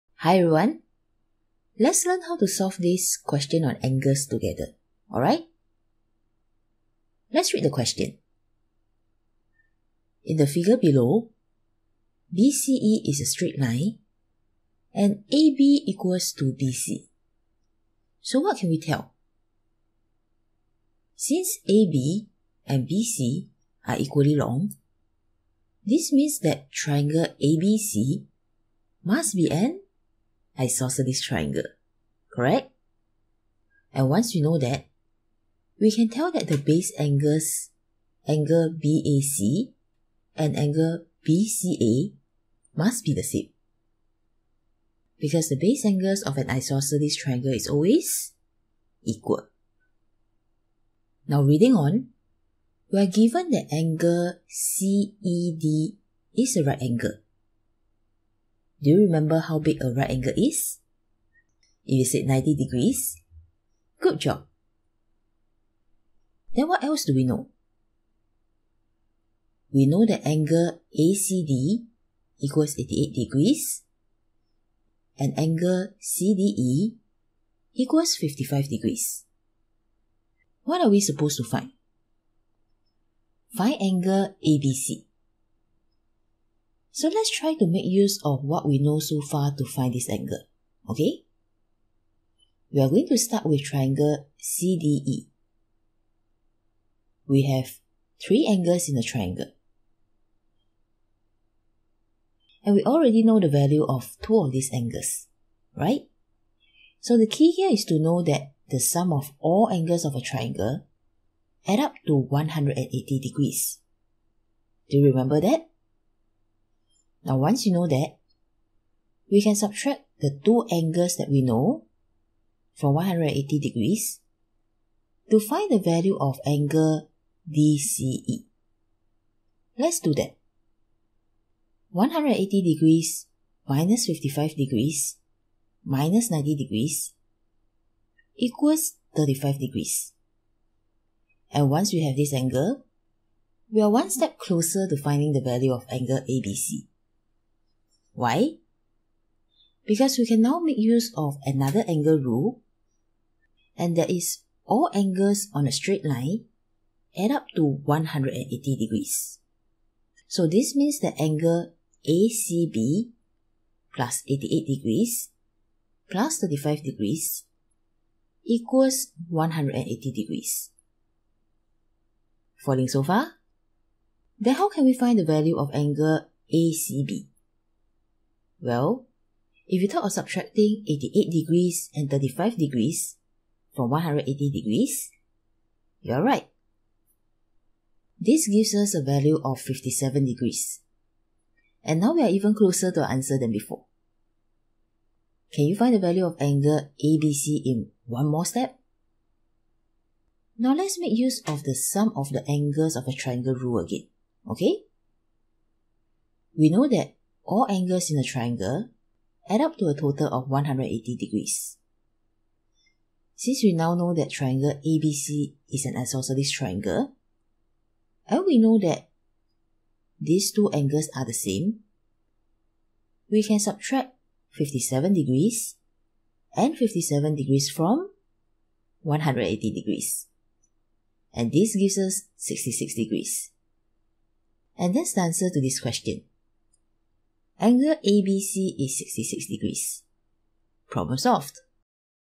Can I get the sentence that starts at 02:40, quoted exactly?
So this means that angle ACB plus 88 degrees plus 35 degrees equals 180 degrees.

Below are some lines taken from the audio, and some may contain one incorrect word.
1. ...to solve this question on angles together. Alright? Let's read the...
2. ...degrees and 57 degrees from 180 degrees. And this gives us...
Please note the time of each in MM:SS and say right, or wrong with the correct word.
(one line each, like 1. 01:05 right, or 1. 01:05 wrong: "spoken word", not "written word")
1. 00:02 right
2. 03:45 right.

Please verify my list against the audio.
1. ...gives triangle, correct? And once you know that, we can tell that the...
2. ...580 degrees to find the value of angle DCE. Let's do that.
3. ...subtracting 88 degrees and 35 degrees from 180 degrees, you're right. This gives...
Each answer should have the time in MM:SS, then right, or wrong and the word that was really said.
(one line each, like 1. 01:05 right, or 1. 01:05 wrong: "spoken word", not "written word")
1. 00:30 wrong: "isosceles", not "gives"
2. 02:02 wrong: "180", not "580"
3. 03:00 right.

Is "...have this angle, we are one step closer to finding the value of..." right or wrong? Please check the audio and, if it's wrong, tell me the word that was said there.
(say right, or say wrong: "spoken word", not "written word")
right.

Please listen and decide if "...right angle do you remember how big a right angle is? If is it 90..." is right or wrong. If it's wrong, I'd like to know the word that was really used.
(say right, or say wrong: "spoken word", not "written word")
right.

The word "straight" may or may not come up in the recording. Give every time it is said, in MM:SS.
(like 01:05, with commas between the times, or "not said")
00:13, 02:35.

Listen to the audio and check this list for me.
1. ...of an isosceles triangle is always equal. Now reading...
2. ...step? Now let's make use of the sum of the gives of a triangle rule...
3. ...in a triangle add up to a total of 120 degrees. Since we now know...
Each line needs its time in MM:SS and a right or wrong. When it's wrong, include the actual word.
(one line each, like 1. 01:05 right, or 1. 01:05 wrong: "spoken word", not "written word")
1. 00:46 right
2. 03:18 wrong: "angles", not "gives"
3. 03:28 wrong: "180", not "120".